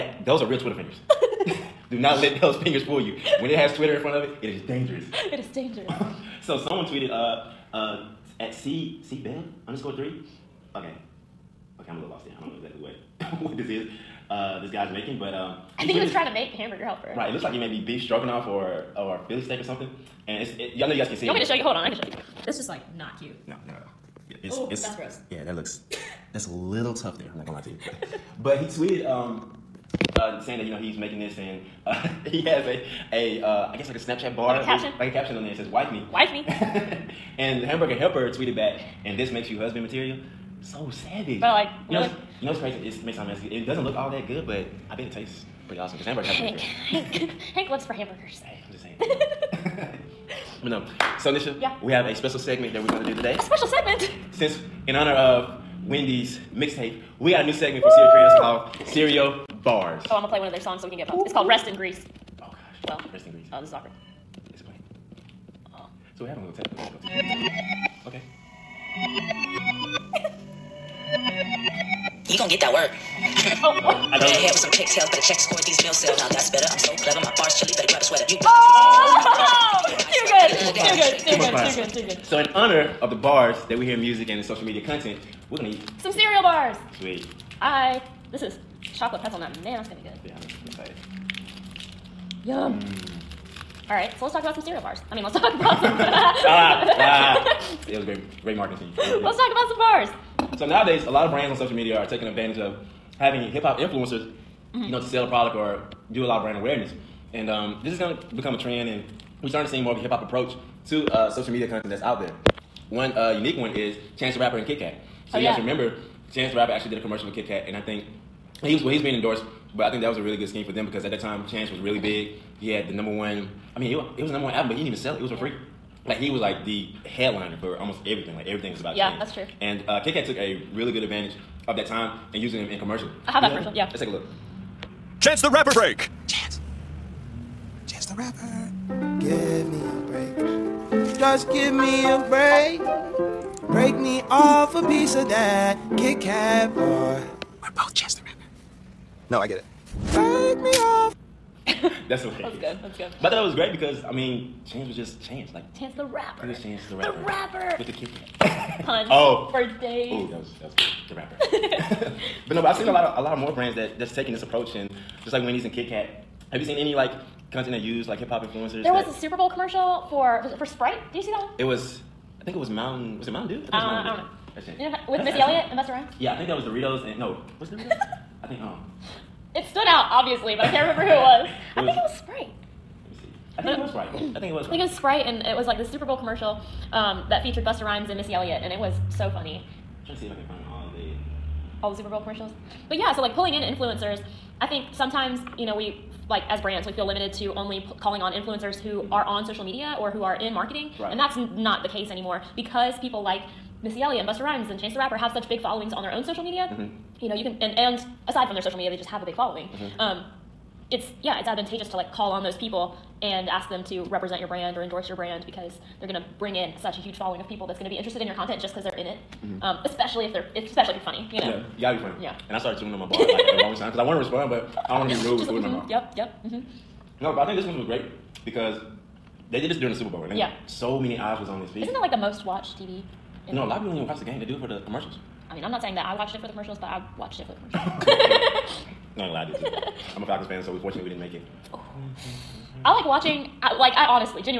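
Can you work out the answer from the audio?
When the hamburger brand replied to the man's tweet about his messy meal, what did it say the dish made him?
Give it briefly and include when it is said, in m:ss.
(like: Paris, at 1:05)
husband material, at 0:39.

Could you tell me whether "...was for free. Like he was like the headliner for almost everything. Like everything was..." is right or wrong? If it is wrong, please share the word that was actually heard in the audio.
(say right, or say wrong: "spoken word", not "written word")
right.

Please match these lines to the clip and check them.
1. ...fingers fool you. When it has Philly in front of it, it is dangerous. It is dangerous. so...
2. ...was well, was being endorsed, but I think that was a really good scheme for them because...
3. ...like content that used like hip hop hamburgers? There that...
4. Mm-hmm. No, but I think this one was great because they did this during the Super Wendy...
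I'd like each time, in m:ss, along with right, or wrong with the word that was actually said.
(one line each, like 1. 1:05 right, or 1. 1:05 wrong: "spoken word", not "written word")
1. 0:02 wrong: "Twitter", not "Philly"
2. 1:58 right
3. 2:46 wrong: "influencers", not "hamburgers"
4. 3:46 wrong: "Bowl", not "Wendy".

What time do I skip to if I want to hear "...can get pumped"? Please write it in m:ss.
1:00.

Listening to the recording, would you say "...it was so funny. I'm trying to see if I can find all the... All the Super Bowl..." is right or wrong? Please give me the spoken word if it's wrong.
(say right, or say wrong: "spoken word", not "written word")
right.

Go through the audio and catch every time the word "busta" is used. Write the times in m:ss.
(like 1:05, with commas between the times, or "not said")
2:55, 3:07, 3:24.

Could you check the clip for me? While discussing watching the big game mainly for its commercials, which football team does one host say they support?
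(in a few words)
Falcons.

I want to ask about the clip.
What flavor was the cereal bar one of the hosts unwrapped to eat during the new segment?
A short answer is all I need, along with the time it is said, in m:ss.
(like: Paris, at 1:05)
chocolate pretzel nut, at 1:28.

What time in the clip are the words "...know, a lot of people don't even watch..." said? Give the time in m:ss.
3:53.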